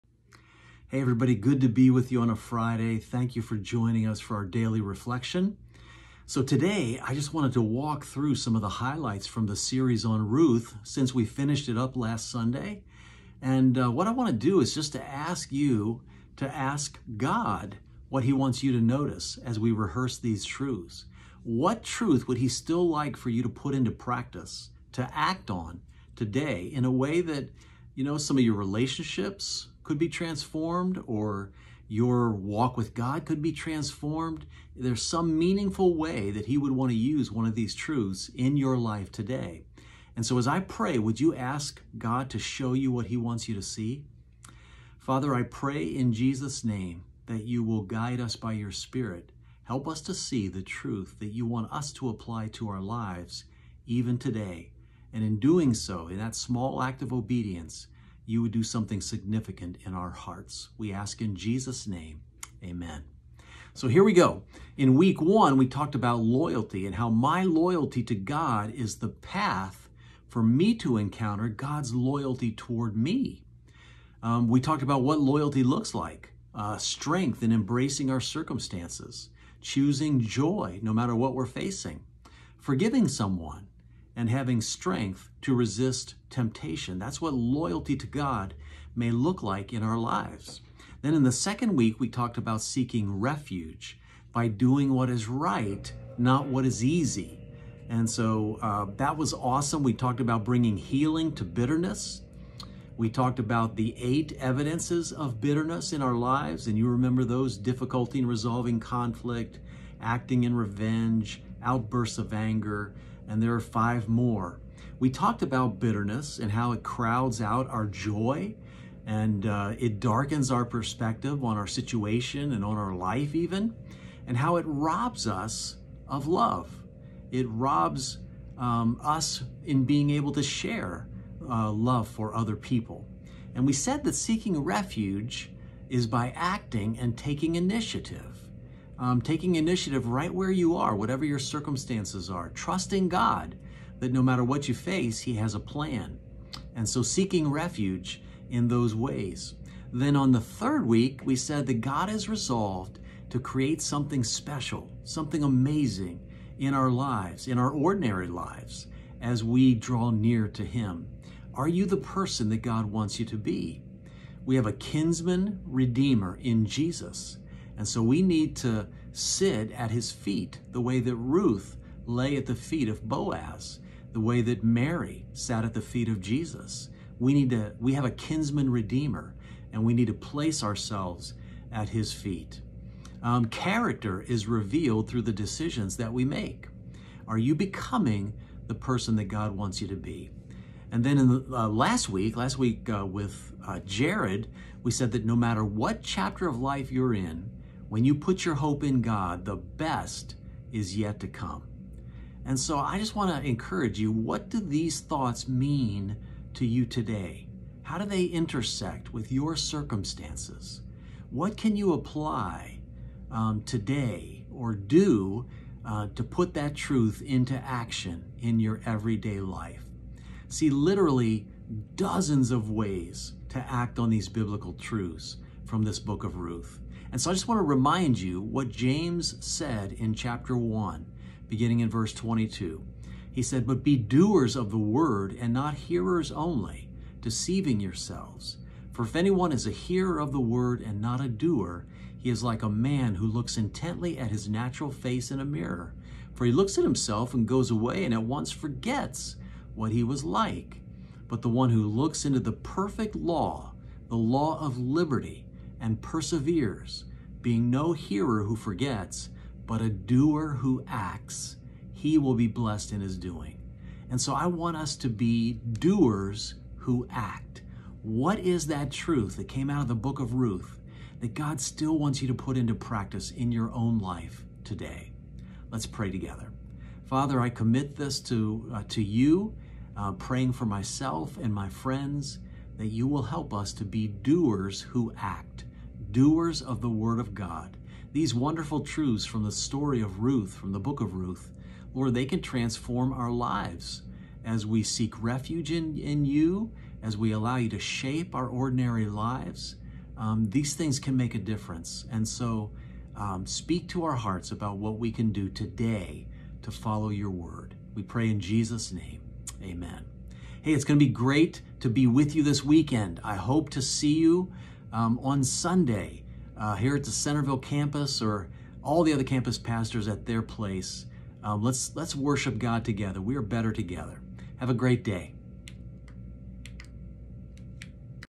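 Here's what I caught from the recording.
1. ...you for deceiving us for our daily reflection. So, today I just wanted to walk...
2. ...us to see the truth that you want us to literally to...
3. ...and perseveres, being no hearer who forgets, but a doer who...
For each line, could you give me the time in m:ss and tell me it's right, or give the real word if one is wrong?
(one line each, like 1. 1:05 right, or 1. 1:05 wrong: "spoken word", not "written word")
1. 0:03 wrong: "joining", not "deceiving"
2. 0:49 wrong: "apply", not "literally"
3. 4:15 right.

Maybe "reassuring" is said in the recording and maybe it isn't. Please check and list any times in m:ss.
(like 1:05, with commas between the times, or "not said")
not said.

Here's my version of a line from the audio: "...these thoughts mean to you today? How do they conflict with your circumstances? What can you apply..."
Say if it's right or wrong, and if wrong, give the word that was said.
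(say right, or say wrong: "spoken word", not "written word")
wrong: "intersect", not "conflict".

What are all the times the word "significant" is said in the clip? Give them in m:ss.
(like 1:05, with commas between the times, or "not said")
0:59.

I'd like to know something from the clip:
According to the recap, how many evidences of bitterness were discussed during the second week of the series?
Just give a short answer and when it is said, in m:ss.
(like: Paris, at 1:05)
8, at 1:43.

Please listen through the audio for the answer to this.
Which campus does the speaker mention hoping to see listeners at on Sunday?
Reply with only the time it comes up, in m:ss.
5:17.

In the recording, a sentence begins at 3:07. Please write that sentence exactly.
Are you becoming the person that God wants you to be?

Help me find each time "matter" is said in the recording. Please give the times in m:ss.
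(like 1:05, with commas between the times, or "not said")
1:20, 2:24, 3:15.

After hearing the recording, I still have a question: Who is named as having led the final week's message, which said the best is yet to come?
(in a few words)
Jared.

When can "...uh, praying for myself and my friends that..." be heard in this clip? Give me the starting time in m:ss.
4:39.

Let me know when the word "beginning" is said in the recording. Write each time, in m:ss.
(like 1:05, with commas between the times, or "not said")
3:51.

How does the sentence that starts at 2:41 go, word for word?
Are you the person that God wants you to be?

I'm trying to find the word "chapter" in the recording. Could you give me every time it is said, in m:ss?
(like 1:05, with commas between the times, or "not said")
3:16, 3:50.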